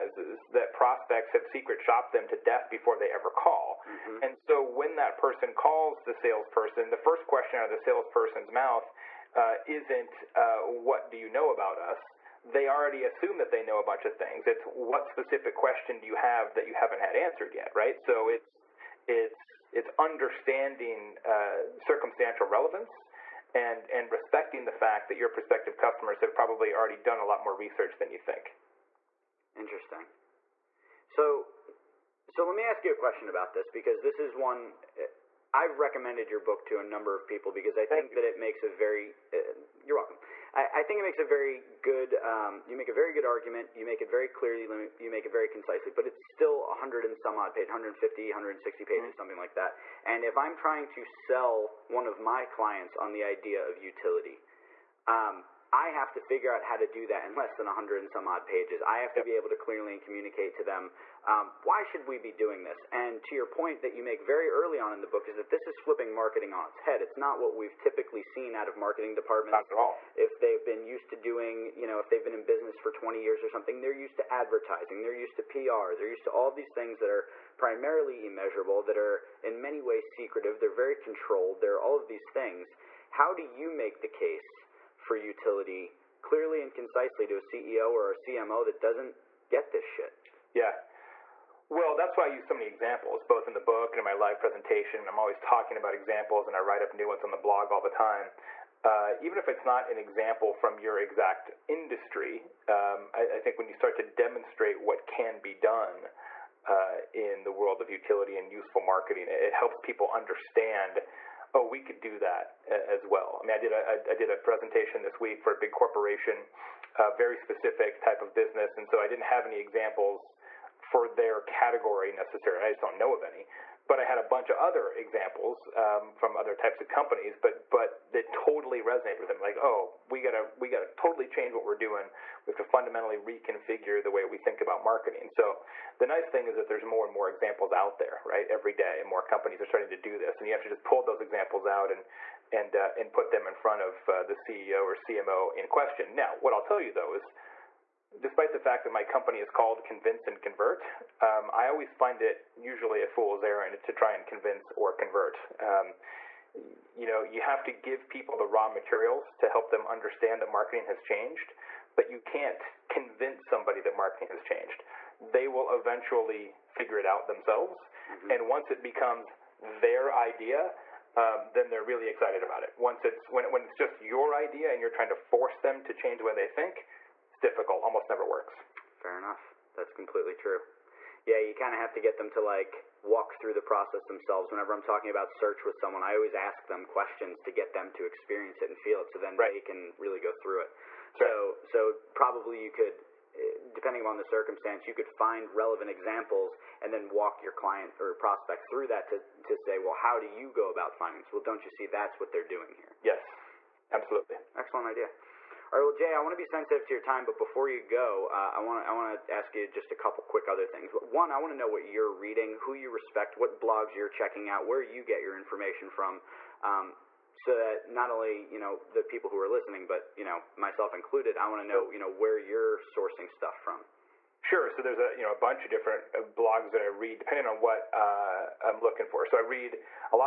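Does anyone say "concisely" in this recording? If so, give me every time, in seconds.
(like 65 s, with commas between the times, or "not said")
45 s, 86 s.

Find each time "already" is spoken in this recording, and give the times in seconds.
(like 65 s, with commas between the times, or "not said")
12 s, 26 s.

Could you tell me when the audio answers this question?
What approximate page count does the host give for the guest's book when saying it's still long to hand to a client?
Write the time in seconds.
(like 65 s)
47 s.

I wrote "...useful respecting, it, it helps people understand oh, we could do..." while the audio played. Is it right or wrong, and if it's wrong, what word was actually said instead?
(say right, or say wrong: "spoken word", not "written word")
wrong: "marketing", not "respecting".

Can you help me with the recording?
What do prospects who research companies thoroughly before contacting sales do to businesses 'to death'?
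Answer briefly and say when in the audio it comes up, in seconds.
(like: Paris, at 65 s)
secret shopped, at 1 s.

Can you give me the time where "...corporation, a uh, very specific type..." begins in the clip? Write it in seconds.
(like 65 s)
115 s.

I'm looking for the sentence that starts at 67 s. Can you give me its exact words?
It's not what we've typically seen out of marketing departments.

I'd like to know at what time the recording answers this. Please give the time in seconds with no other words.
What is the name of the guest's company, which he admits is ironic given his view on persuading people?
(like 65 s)
149 s.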